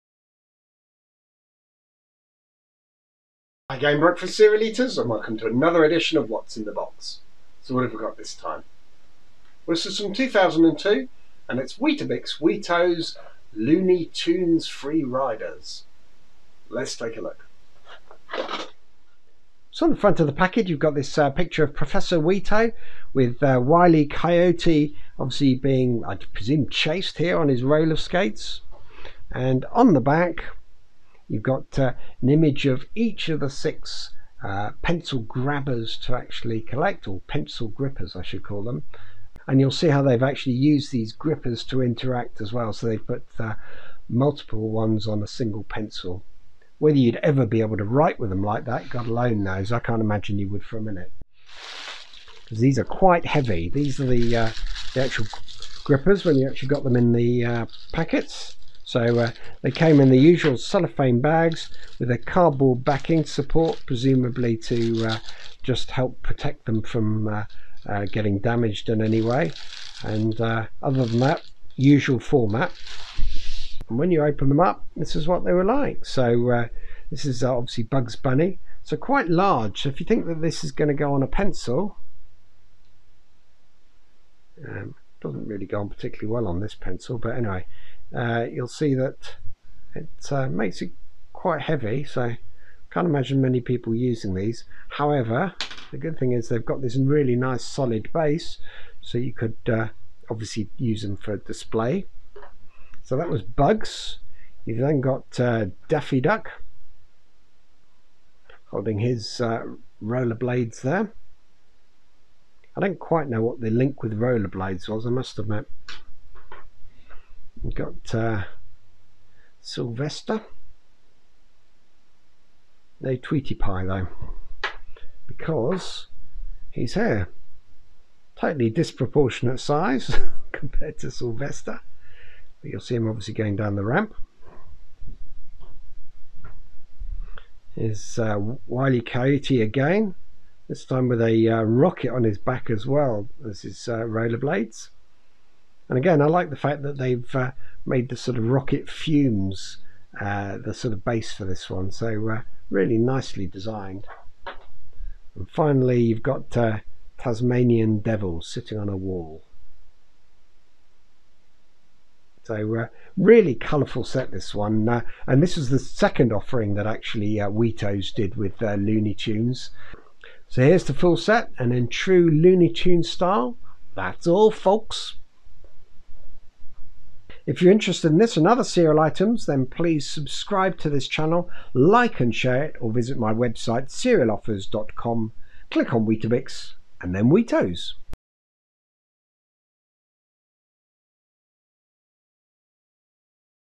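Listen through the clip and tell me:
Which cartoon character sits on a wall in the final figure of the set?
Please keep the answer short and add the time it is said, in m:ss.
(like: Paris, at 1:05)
Tasmanian Devil, at 2:37.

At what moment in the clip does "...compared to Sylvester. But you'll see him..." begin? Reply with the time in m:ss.
2:10.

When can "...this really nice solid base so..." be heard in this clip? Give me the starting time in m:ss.
1:36.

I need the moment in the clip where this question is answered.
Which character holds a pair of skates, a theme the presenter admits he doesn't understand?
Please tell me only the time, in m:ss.
1:45.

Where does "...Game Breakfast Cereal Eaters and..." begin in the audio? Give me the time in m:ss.
0:03.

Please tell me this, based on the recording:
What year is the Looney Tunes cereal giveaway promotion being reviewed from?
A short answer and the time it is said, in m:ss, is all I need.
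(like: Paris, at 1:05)
2002, at 0:10.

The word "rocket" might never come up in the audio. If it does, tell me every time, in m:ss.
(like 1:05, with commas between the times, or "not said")
2:21, 2:28.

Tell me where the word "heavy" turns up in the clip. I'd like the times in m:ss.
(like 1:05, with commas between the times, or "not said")
0:53, 1:31.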